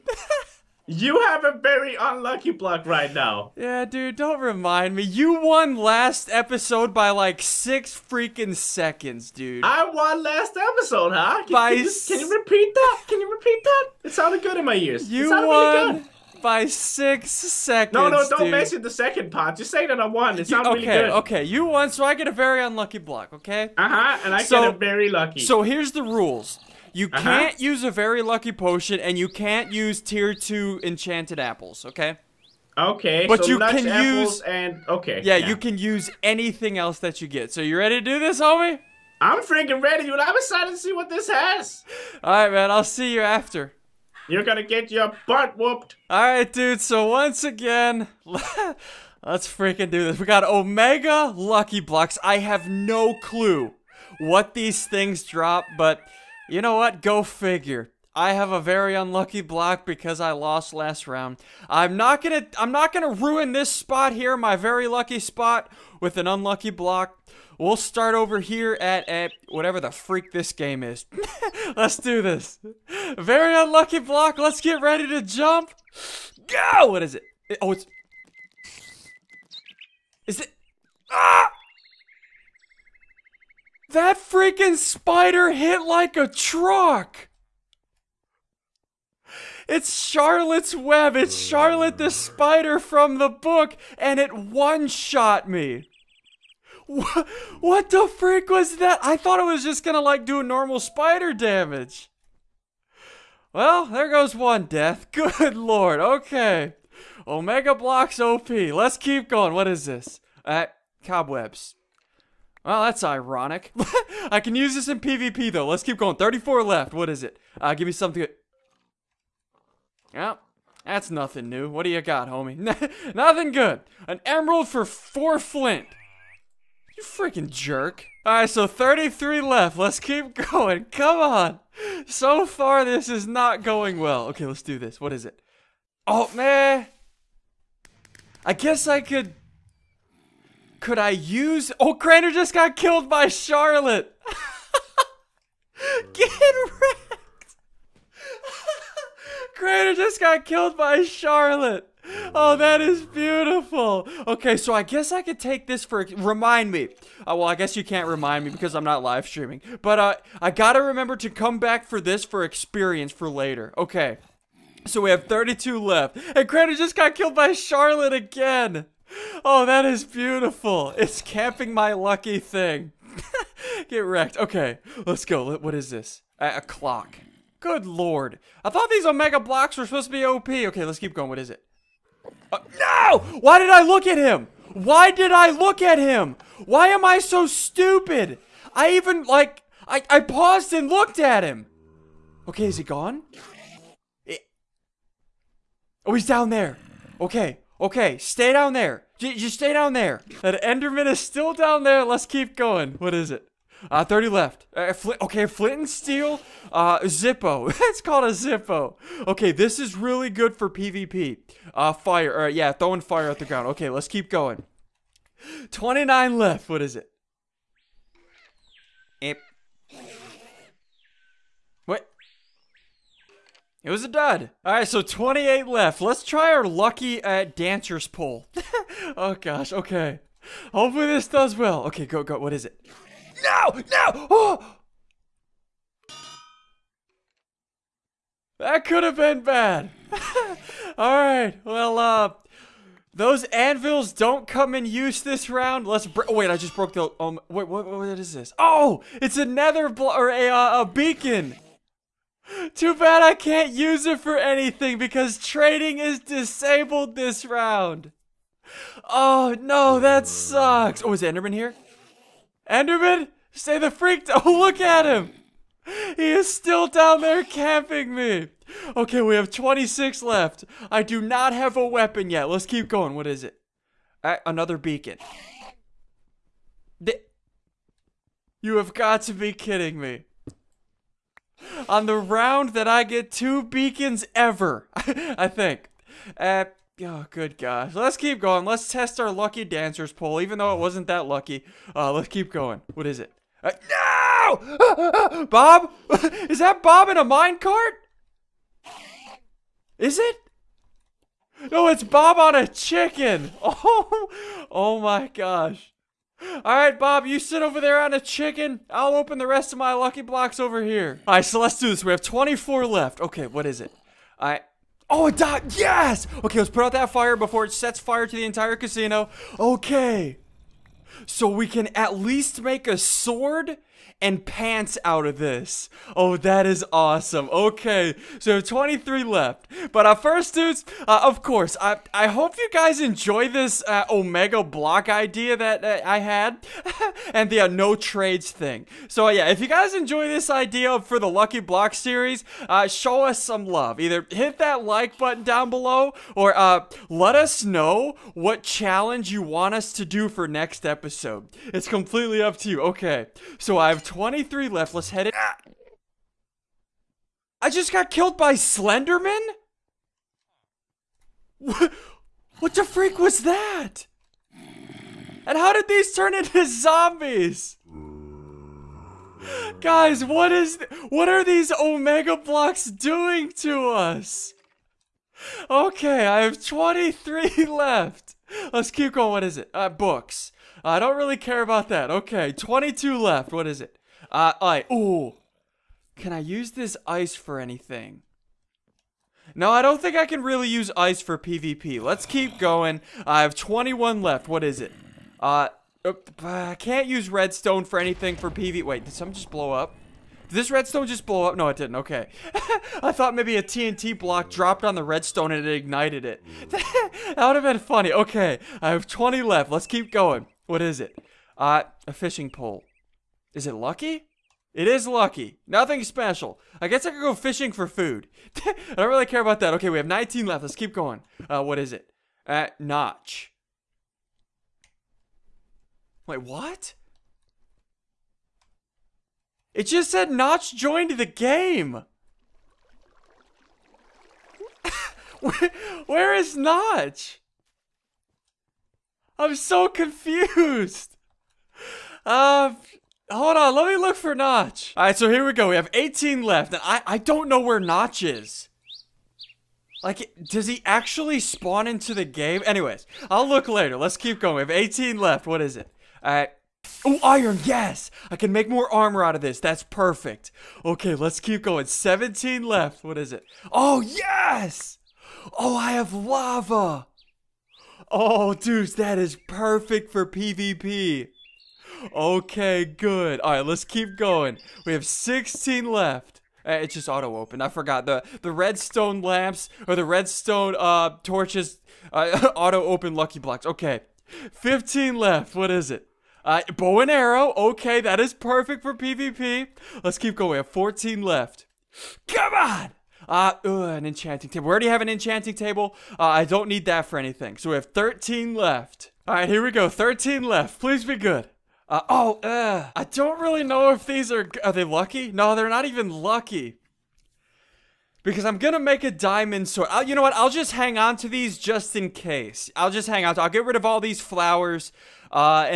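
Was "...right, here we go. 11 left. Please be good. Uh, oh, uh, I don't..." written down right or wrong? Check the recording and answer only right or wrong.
wrong.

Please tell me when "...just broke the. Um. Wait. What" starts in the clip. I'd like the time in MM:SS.
04:06.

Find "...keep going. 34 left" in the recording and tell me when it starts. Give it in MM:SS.
01:55.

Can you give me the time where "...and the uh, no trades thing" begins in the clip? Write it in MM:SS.
05:37.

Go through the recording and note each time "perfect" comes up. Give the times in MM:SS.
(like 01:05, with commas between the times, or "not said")
07:39, 07:49, 08:08.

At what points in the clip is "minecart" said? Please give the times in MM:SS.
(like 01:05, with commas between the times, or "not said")
04:57.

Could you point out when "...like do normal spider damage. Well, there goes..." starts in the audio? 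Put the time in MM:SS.
01:40.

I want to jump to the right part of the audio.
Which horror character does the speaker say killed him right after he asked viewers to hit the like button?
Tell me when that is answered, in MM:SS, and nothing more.
05:58.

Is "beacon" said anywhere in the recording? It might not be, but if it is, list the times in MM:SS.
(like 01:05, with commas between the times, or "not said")
04:10, 04:34, 04:43.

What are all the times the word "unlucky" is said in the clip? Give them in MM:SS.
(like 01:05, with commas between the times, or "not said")
00:01, 00:22, 00:58, 01:06, 01:13.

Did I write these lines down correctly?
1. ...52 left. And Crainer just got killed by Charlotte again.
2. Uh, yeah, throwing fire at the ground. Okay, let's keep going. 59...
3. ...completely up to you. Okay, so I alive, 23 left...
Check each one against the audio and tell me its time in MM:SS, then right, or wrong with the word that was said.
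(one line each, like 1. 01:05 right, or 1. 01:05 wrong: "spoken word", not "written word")
1. 02:45 wrong: "32", not "52"
2. 03:32 wrong: "29", not "59"
3. 05:51 right.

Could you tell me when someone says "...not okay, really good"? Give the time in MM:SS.
00:20.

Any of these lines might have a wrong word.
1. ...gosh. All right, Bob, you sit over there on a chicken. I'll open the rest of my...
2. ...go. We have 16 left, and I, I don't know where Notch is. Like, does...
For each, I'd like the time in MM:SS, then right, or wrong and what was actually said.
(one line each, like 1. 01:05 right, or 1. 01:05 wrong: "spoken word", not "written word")
1. 05:05 right
2. 07:25 wrong: "18", not "16".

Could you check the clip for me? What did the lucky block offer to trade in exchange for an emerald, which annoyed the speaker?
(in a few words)
four flint.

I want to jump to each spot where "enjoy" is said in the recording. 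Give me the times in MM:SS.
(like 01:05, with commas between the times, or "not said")
05:32, 05:39.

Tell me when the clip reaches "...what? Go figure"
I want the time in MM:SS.
00:56.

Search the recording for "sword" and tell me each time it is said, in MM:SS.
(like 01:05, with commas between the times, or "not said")
05:22, 08:29.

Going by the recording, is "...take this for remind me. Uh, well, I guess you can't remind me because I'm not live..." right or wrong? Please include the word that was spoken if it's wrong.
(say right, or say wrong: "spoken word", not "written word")
right.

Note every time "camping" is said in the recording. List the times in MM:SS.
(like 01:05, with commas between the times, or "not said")
02:51, 04:27.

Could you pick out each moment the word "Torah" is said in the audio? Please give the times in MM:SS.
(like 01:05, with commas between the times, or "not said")
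not said.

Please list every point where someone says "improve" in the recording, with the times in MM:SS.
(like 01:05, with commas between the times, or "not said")
not said.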